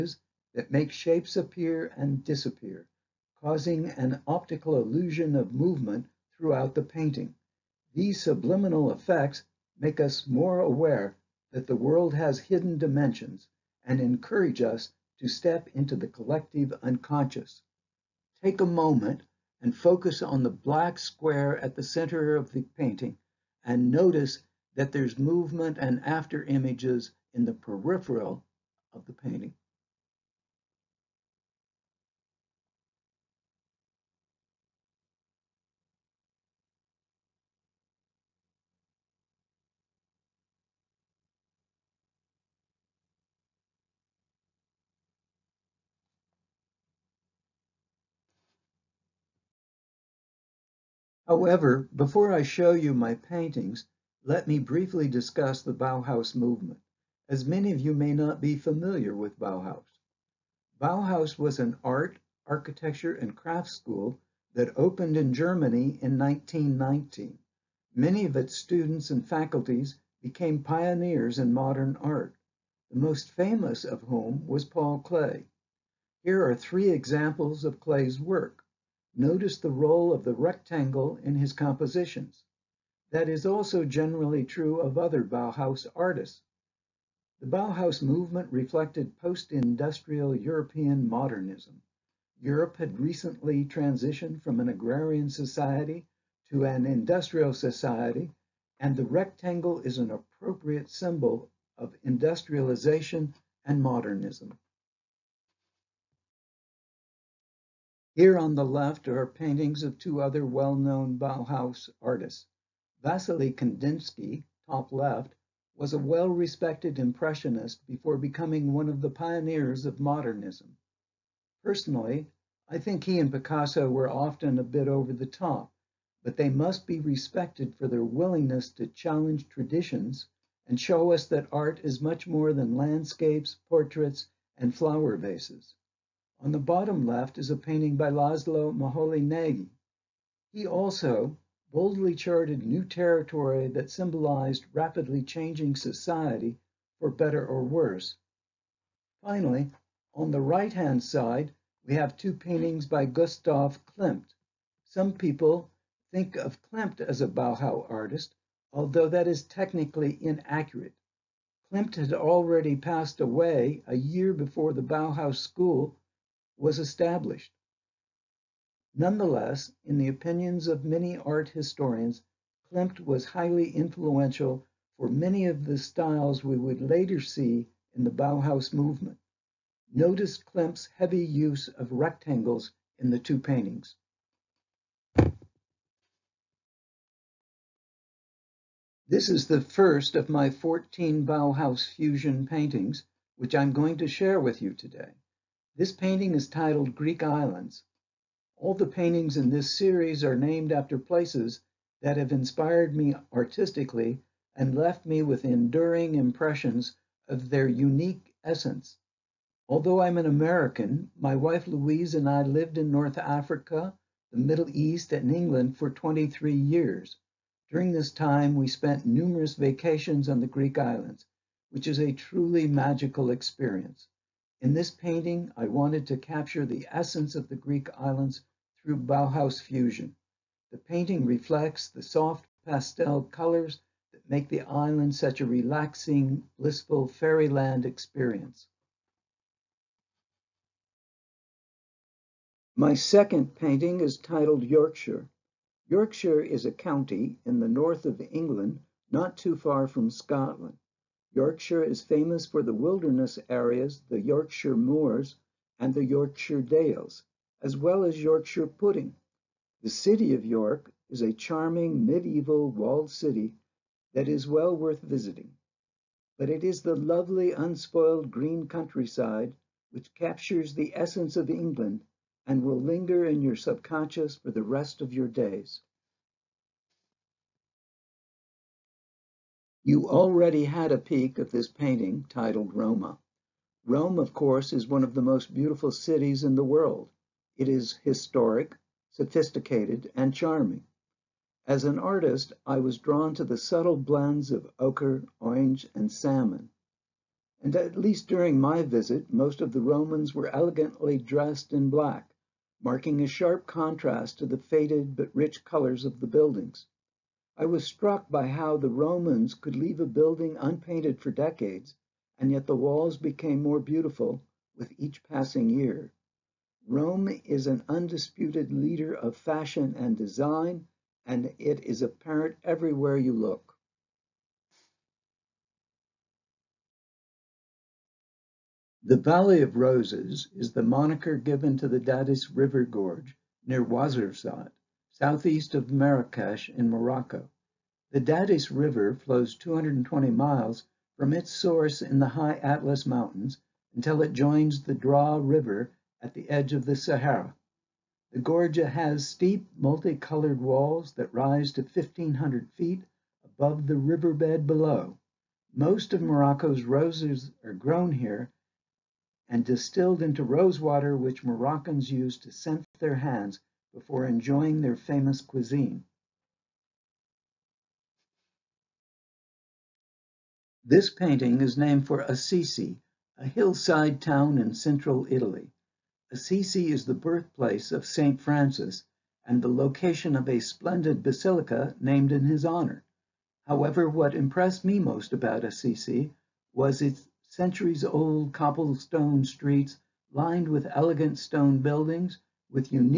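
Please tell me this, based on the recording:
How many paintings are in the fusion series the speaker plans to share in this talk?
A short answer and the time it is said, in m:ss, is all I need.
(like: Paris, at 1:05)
14, at 3:10.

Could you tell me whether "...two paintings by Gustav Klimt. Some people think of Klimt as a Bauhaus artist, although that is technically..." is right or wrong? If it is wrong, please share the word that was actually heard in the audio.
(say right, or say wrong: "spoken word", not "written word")
right.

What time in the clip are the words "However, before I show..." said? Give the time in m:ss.
0:51.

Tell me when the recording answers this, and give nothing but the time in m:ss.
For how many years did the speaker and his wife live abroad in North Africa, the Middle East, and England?
3:35.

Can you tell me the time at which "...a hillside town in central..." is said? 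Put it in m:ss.
6:13.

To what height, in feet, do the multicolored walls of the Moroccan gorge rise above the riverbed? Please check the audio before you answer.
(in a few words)
1,500 feet.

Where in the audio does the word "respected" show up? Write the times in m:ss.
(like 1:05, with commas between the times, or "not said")
1:55, 2:06.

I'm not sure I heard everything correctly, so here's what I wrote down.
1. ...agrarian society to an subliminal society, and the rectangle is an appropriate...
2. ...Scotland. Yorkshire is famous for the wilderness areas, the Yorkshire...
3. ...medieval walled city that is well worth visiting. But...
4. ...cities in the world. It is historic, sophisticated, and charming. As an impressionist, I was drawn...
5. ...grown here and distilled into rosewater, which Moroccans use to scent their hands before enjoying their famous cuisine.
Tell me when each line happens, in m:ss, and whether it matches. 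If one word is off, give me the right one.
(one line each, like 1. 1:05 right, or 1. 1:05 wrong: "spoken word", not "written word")
1. 1:34 wrong: "industrial", not "subliminal"
2. 4:10 right
3. 4:22 right
4. 4:45 wrong: "artist", not "impressionist"
5. 5:57 right.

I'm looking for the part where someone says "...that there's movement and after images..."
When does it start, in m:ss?
0:24.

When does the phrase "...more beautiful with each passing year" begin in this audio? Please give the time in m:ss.
5:13.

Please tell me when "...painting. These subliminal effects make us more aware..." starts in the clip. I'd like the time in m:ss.
0:06.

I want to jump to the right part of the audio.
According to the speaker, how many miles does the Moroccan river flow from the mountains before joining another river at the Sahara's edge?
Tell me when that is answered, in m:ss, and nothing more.
5:39.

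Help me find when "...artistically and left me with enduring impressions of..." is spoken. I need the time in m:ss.
3:23.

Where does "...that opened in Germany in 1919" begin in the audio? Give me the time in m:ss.
1:04.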